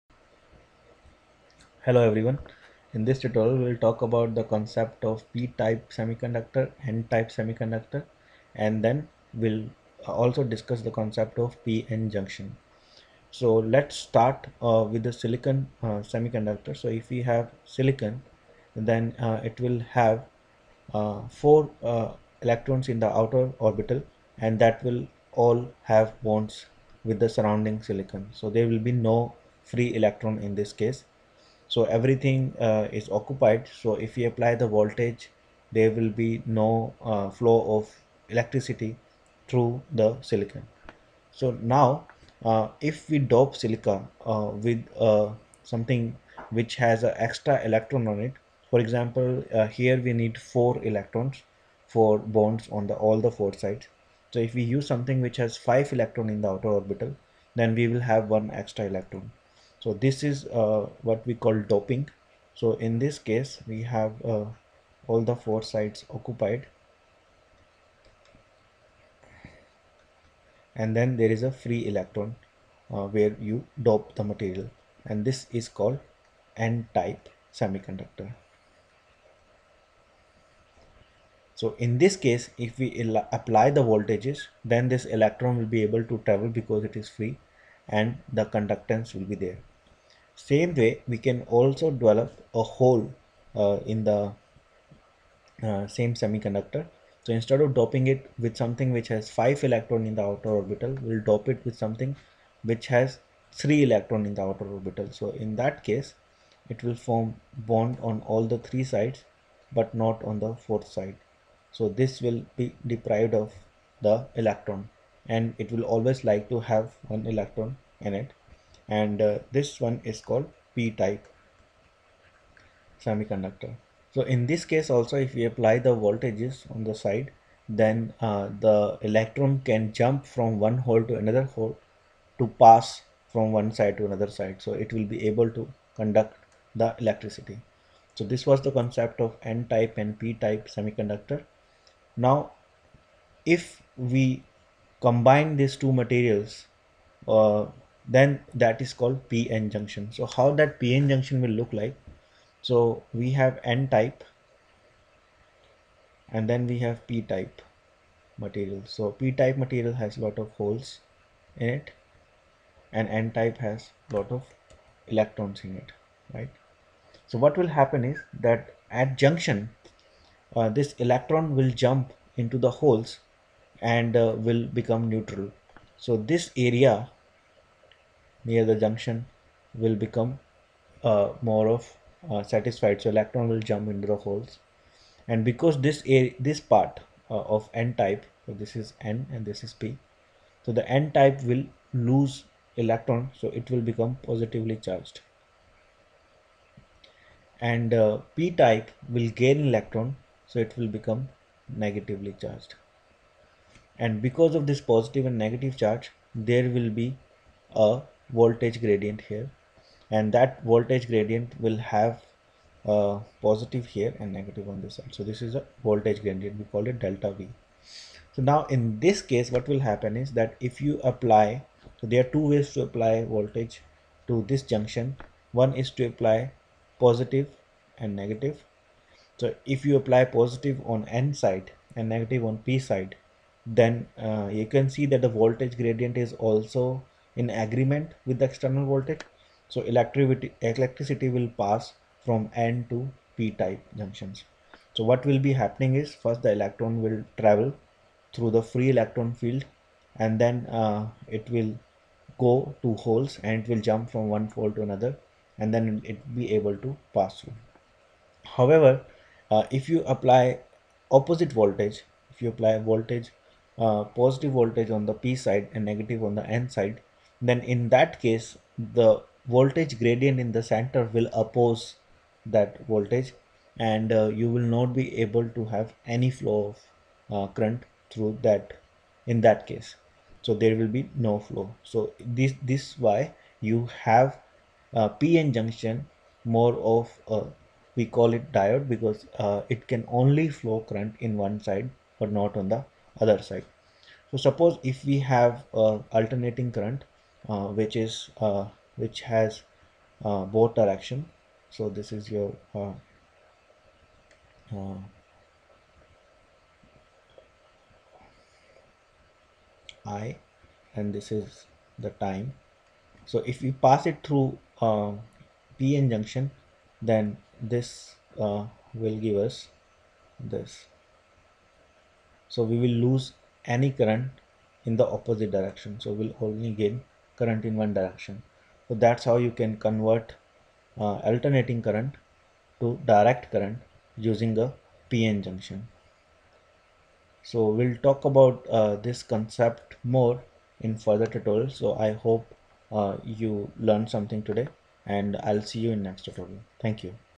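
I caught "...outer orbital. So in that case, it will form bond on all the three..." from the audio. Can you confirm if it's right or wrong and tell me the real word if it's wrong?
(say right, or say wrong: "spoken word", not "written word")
right.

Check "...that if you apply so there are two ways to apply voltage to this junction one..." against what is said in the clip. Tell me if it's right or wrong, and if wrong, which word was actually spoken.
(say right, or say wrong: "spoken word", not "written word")
right.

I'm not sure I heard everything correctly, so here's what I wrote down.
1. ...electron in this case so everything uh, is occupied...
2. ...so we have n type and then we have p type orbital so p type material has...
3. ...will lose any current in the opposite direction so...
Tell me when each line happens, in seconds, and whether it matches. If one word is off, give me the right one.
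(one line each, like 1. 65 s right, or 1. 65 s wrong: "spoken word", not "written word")
1. 29 s right
2. 152 s wrong: "material", not "orbital"
3. 322 s right.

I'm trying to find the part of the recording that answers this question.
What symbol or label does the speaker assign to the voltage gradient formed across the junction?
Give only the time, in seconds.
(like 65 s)
217 s.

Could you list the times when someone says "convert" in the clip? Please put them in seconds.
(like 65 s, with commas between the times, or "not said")
329 s.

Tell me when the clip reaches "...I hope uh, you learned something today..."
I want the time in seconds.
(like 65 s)
342 s.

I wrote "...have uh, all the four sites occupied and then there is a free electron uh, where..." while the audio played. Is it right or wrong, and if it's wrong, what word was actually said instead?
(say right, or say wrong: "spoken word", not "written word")
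right.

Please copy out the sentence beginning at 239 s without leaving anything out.
So electricity, electricity will pass from N to P type junctions.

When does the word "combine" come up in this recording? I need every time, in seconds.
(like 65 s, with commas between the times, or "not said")
145 s.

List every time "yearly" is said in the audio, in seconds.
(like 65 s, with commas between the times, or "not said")
not said.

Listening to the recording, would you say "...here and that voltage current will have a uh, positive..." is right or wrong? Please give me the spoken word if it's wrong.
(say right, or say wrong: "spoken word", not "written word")
wrong: "gradient", not "current".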